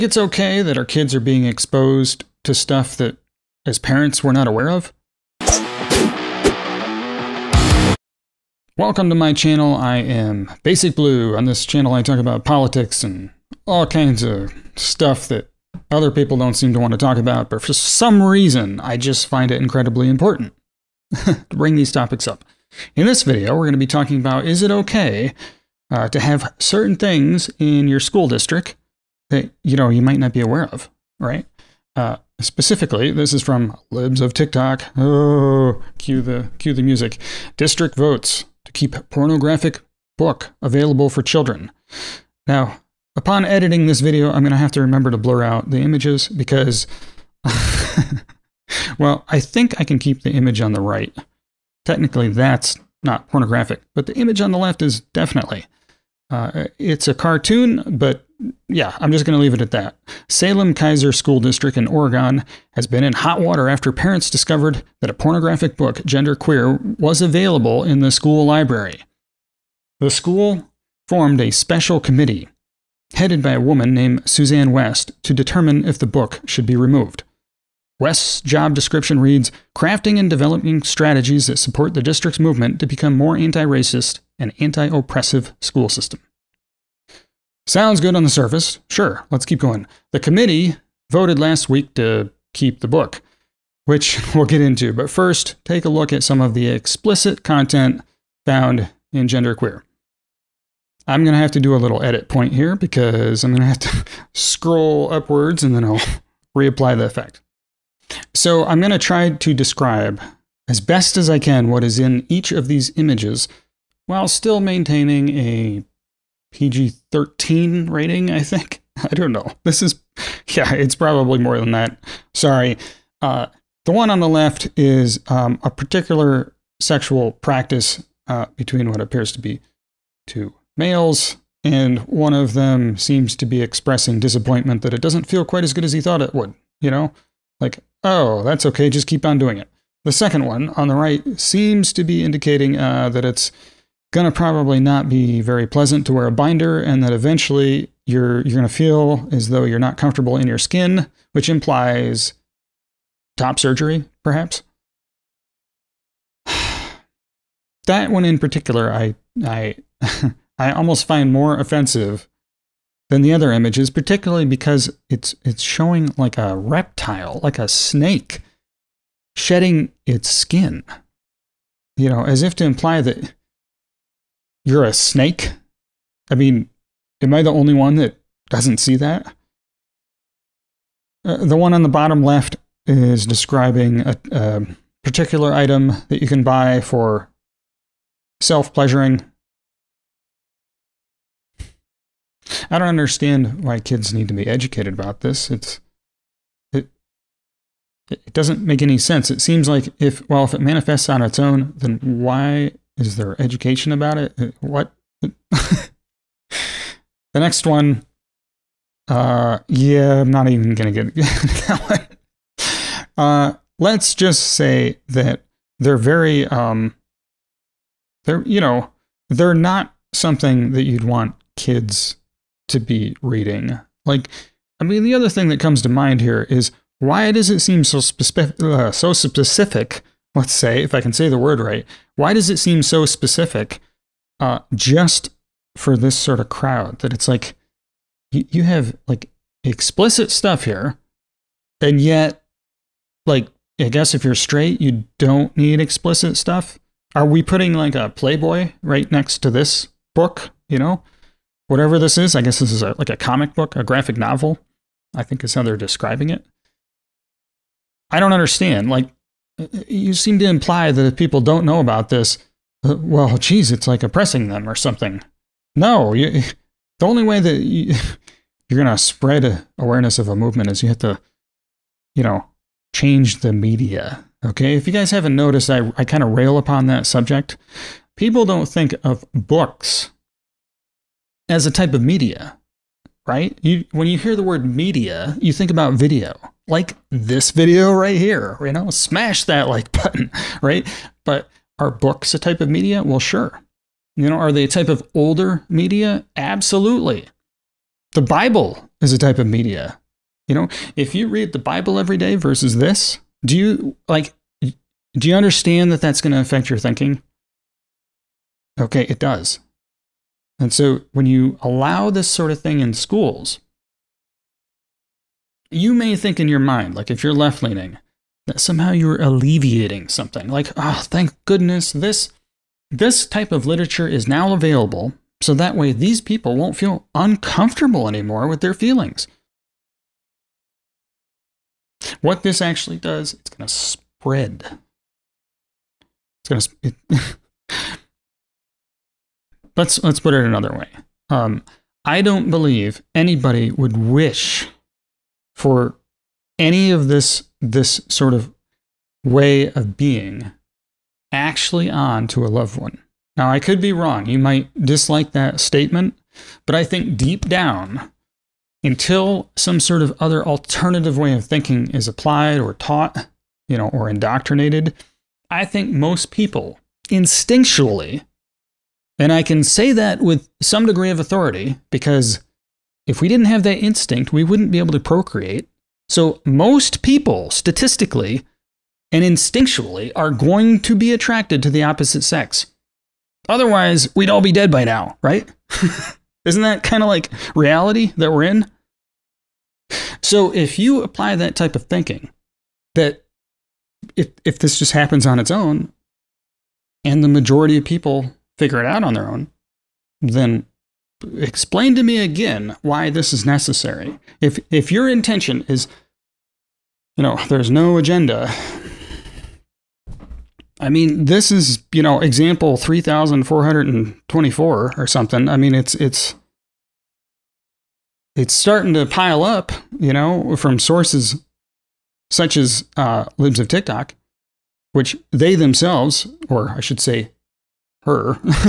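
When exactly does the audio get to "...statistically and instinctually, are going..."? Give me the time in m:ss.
6:17.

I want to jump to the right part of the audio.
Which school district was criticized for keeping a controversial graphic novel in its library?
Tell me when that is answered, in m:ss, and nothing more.
1:00.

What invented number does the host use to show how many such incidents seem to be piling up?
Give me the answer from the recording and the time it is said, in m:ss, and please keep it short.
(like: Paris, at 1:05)
3424, at 6:52.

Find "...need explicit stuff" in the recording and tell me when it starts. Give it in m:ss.
4:05.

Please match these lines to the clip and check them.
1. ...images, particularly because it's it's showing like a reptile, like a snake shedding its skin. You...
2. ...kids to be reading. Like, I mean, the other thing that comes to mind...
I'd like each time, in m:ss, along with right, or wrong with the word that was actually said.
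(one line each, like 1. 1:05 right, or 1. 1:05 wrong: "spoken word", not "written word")
1. 2:43 right
2. 3:41 right.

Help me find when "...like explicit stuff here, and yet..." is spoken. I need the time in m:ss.
3:59.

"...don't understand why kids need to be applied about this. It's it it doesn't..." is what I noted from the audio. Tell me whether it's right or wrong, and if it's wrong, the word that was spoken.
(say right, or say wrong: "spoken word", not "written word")
wrong: "educated", not "applied".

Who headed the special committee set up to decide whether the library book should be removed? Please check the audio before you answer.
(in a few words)
Suzanne West.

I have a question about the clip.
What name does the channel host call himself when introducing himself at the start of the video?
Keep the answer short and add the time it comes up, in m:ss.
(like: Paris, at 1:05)
Basic Blue, at 0:10.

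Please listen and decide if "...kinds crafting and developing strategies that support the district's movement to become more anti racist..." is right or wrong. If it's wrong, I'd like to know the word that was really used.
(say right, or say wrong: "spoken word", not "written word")
wrong: "reads", not "kinds".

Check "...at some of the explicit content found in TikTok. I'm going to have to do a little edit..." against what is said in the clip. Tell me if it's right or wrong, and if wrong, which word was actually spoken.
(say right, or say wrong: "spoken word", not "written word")
wrong: "Genderqueer", not "TikTok".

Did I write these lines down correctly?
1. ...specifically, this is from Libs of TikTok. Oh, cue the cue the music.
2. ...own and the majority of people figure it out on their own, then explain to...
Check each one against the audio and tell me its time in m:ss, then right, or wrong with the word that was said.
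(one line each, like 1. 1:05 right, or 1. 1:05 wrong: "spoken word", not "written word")
1. 0:32 right
2. 6:35 right.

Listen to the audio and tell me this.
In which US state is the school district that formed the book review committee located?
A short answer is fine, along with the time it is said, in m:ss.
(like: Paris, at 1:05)
Oregon, at 1:01.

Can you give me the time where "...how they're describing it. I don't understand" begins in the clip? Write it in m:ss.
4:15.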